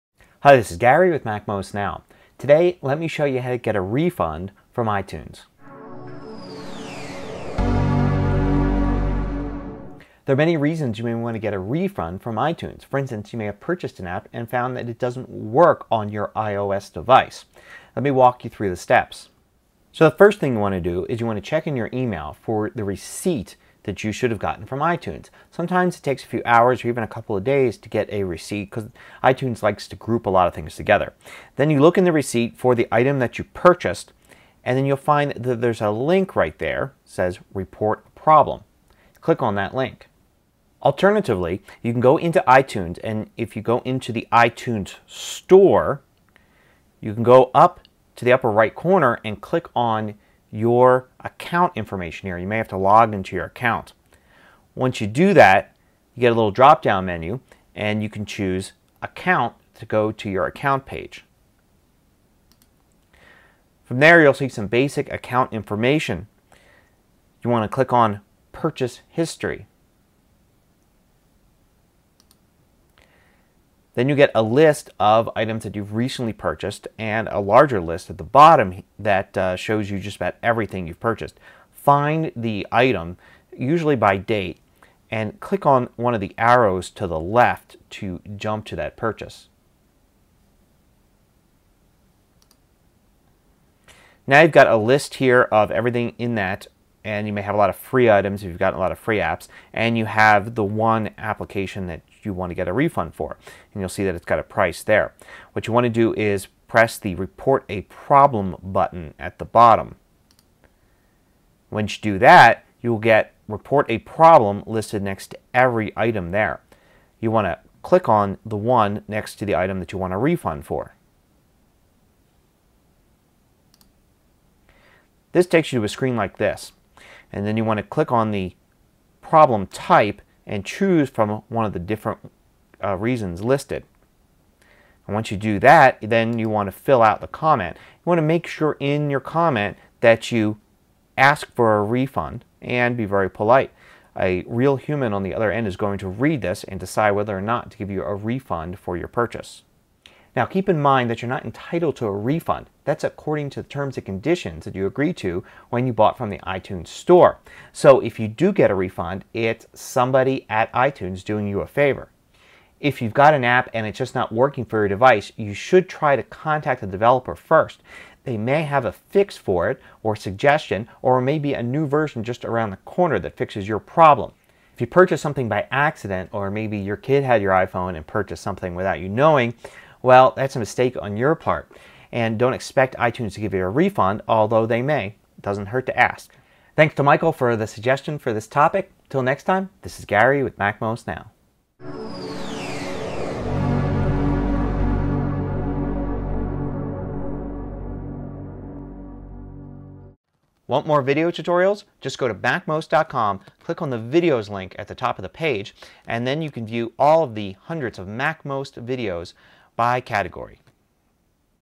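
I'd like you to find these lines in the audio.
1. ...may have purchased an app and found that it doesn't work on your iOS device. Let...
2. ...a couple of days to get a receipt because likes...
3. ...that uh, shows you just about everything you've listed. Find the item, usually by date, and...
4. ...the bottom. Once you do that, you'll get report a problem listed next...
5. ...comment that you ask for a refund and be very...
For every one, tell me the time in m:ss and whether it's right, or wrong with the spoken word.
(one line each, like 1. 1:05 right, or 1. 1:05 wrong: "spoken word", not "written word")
1. 0:13 right
2. 0:27 wrong: "iTunes", not "likes"
3. 1:18 wrong: "purchased", not "listed"
4. 1:49 right
5. 2:19 right.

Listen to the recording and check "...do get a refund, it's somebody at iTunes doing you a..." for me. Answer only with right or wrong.
right.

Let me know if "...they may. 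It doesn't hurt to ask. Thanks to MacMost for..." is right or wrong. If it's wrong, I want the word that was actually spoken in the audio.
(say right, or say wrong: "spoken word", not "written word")
wrong: "Michael", not "MacMost".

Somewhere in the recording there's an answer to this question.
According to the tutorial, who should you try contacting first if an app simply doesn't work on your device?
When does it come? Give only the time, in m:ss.
2:46.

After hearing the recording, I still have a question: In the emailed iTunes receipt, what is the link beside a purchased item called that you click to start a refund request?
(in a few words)
Report problem.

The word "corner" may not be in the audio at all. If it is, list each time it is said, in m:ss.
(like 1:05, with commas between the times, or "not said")
0:48, 2:52.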